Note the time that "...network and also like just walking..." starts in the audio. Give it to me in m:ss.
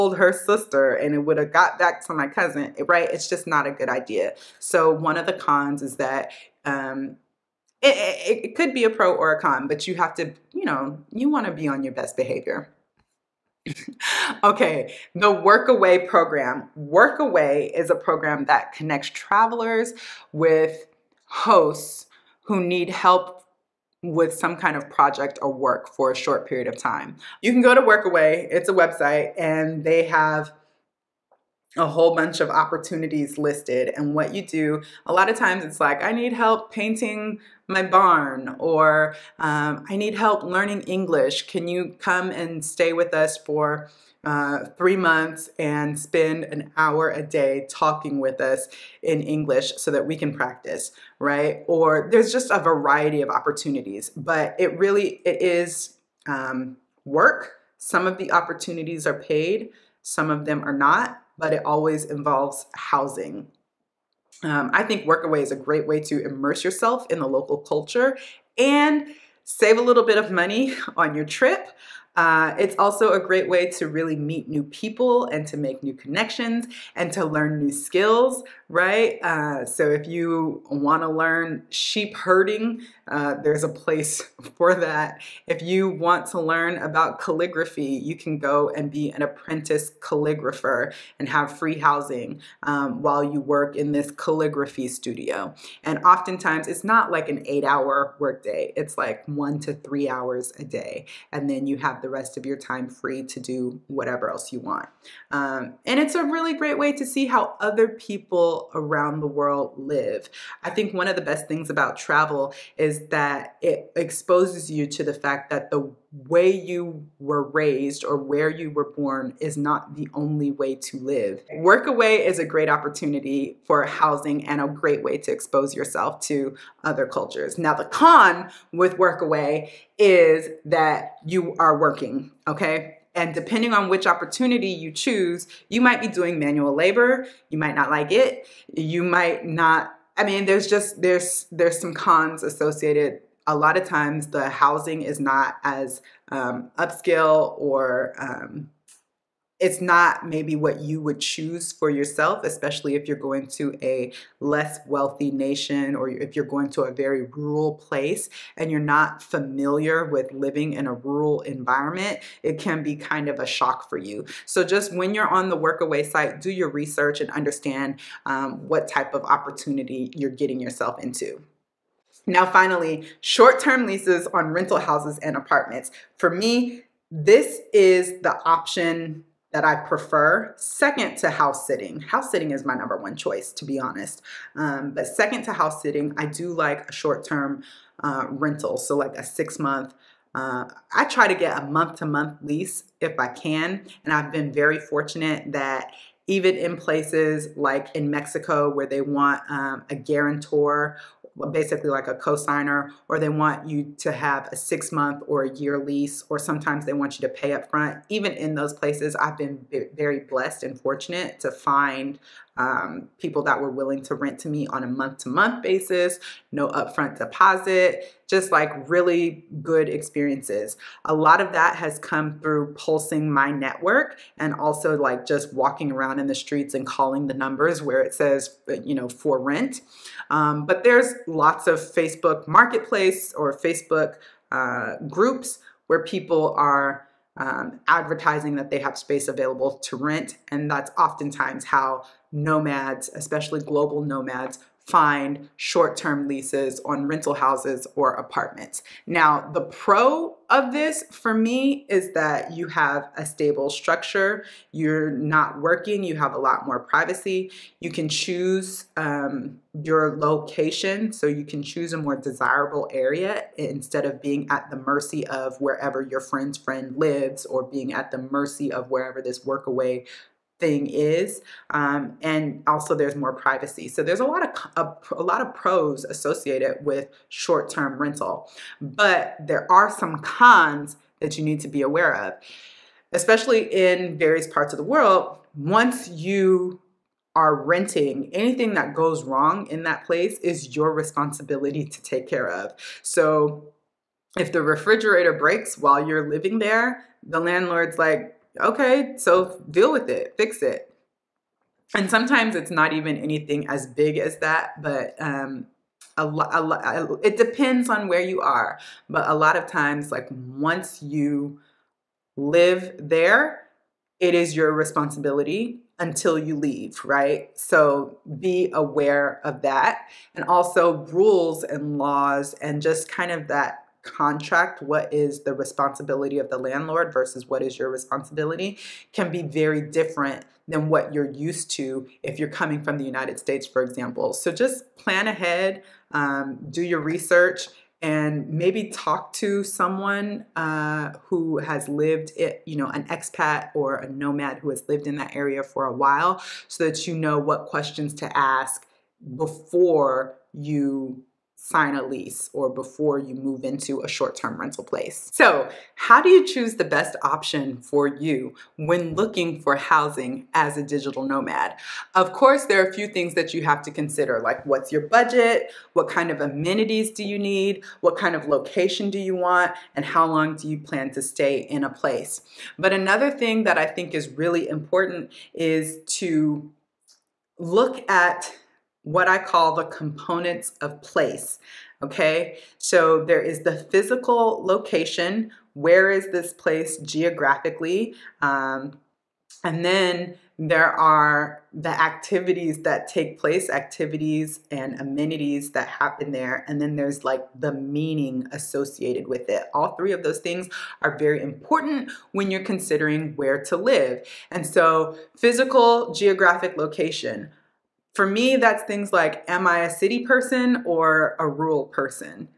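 3:43.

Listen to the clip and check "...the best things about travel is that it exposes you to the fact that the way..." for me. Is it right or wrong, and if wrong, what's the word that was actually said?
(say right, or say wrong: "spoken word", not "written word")
right.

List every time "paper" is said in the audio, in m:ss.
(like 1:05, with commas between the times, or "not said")
not said.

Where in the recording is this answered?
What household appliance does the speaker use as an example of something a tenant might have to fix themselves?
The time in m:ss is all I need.
4:54.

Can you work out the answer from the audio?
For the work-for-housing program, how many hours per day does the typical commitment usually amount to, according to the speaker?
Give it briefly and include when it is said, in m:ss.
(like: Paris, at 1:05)
1 to 3 hours, at 1:39.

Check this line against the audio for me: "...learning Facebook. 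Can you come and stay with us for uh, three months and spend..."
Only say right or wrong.
wrong.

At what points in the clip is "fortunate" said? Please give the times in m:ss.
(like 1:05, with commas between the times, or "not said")
3:14, 3:30.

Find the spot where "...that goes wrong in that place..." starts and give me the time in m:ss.
4:48.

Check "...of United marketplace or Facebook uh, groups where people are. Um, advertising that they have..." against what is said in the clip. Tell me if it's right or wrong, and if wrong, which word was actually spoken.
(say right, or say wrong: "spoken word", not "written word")
wrong: "Facebook", not "United".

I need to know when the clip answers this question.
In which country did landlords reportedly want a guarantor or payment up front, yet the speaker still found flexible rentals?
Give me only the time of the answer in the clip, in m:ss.
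3:18.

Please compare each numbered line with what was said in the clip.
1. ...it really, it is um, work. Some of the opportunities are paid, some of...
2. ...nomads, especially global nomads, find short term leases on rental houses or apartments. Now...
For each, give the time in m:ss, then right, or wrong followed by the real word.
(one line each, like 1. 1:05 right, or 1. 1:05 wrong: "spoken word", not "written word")
1. 0:54 right
2. 4:02 right.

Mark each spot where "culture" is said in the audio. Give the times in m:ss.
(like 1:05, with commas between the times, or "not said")
1:07, 2:07.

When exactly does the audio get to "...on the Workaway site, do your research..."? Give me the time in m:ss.
2:45.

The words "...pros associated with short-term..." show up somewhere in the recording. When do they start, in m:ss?
4:35.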